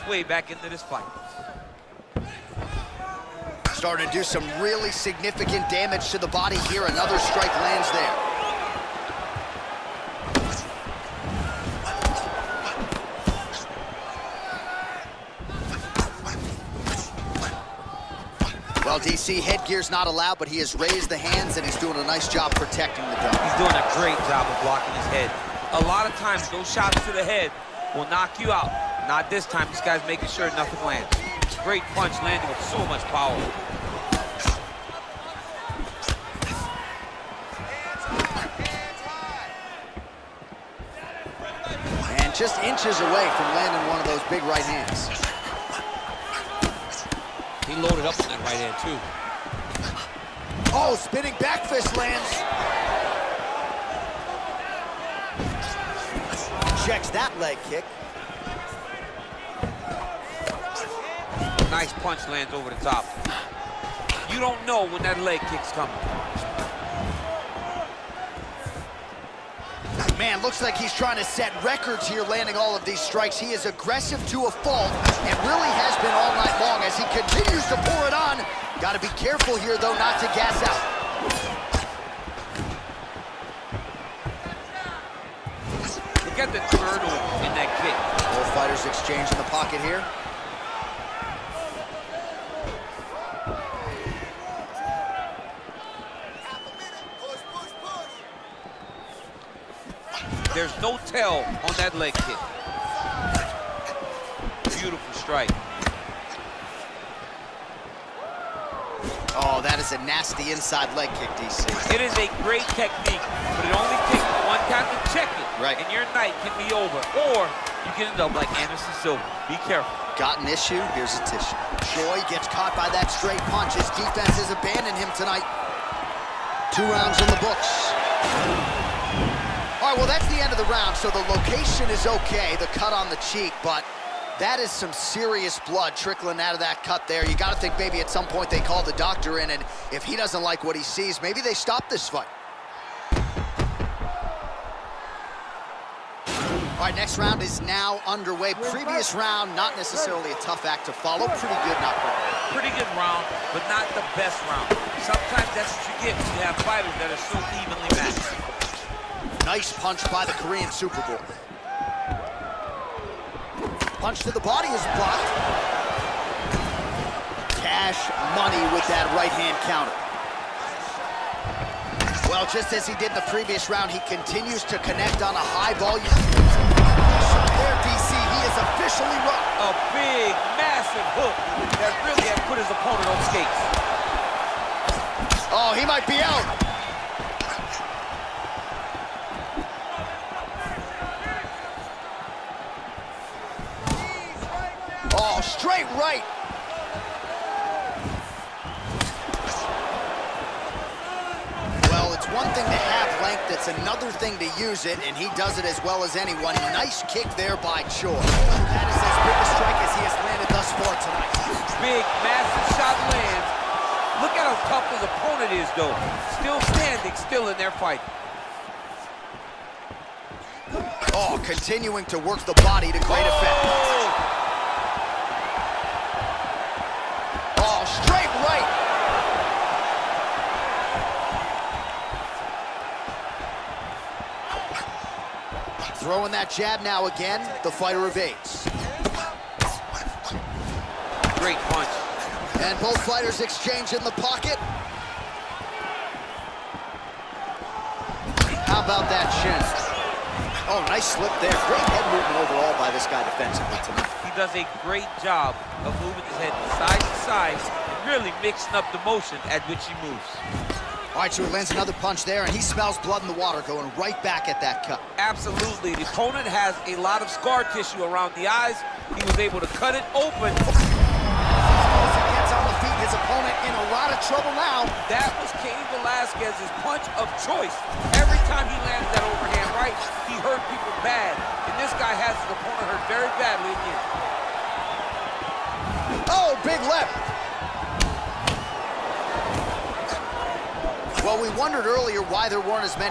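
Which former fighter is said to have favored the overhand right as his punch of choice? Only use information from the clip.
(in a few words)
Cain Velasquez.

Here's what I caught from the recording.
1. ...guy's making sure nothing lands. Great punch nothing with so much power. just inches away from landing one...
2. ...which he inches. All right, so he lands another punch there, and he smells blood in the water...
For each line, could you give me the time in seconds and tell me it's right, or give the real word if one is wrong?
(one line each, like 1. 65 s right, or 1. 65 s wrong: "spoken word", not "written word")
1. 29 s wrong: "landing", not "nothing"
2. 259 s wrong: "moves", not "inches".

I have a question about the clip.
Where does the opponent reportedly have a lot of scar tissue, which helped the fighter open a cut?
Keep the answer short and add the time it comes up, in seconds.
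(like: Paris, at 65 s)
around the eyes, at 268 s.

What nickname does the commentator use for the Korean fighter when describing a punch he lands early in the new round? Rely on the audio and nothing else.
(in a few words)
Superboy.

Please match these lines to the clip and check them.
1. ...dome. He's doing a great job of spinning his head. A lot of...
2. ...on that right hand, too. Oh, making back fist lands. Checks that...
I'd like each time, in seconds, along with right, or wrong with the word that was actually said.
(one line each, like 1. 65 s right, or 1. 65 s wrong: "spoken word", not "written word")
1. 23 s wrong: "blocking", not "spinning"
2. 48 s wrong: "spinning", not "making".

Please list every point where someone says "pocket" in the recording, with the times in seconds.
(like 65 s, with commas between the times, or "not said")
89 s, 244 s.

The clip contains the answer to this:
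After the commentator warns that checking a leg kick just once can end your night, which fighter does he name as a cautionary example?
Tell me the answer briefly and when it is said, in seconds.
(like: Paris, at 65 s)
Anderson Silva, at 118 s.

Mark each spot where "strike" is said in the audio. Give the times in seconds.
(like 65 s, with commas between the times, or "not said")
7 s, 72 s, 105 s, 209 s.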